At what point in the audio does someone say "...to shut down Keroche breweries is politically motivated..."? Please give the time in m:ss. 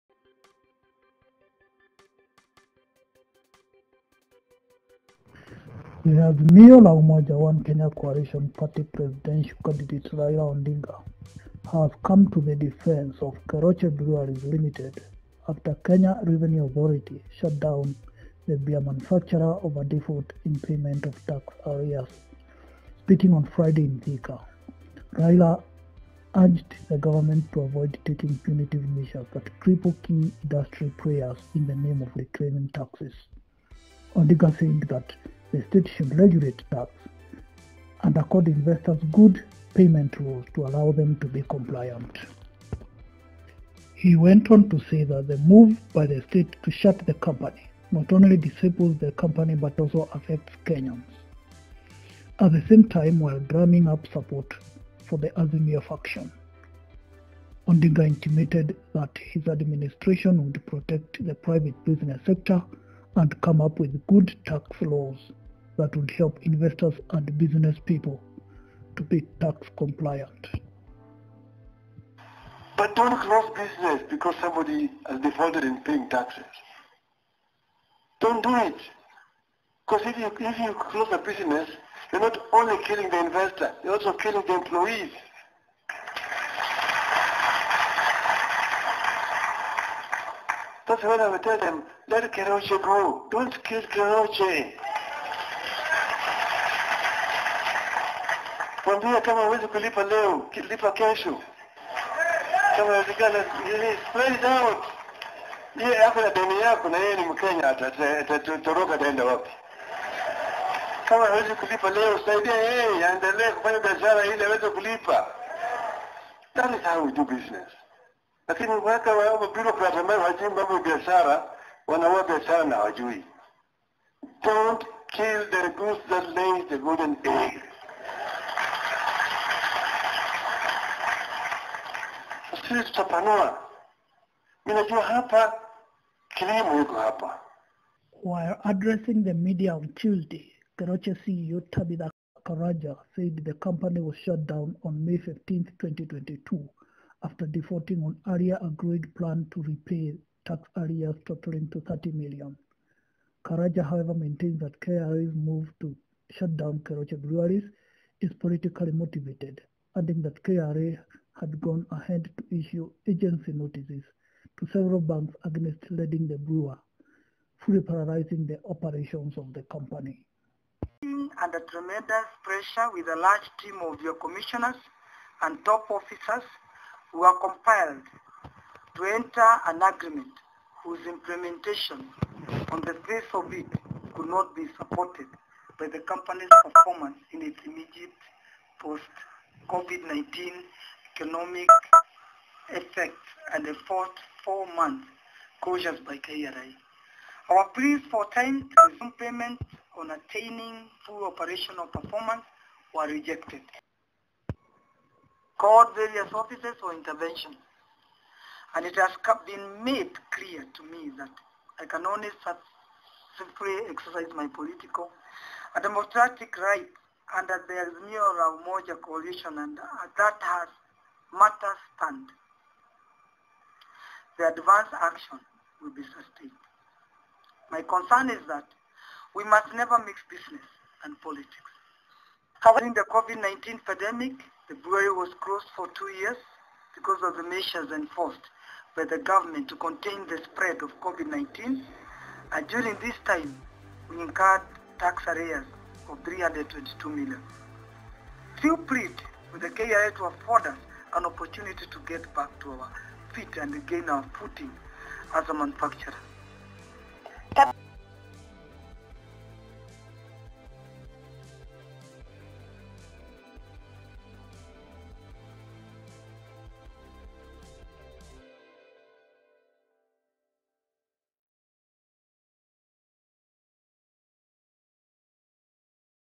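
2:35.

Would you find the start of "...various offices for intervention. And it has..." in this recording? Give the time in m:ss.
3:25.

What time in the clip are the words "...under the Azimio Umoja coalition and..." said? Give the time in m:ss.
3:37.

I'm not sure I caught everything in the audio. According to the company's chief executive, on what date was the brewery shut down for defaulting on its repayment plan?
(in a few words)
May 15, 2022.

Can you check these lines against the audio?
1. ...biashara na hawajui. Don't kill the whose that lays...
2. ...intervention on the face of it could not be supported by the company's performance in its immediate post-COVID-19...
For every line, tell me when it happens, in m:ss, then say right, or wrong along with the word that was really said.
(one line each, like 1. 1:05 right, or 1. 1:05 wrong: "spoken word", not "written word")
1. 2:02 wrong: "goose", not "whose"
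2. 3:01 wrong: "implementation", not "intervention".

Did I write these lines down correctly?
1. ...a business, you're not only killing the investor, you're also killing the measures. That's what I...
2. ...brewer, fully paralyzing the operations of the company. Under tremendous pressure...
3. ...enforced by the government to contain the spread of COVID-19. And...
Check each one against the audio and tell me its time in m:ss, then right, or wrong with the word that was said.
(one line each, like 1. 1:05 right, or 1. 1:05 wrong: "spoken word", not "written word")
1. 1:21 wrong: "employees", not "measures"
2. 2:46 right
3. 3:57 right.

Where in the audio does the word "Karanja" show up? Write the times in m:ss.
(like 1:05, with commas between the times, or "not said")
2:22, 2:33.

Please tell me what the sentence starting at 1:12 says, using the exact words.
But don't close business because somebody has defaulted in paying taxes.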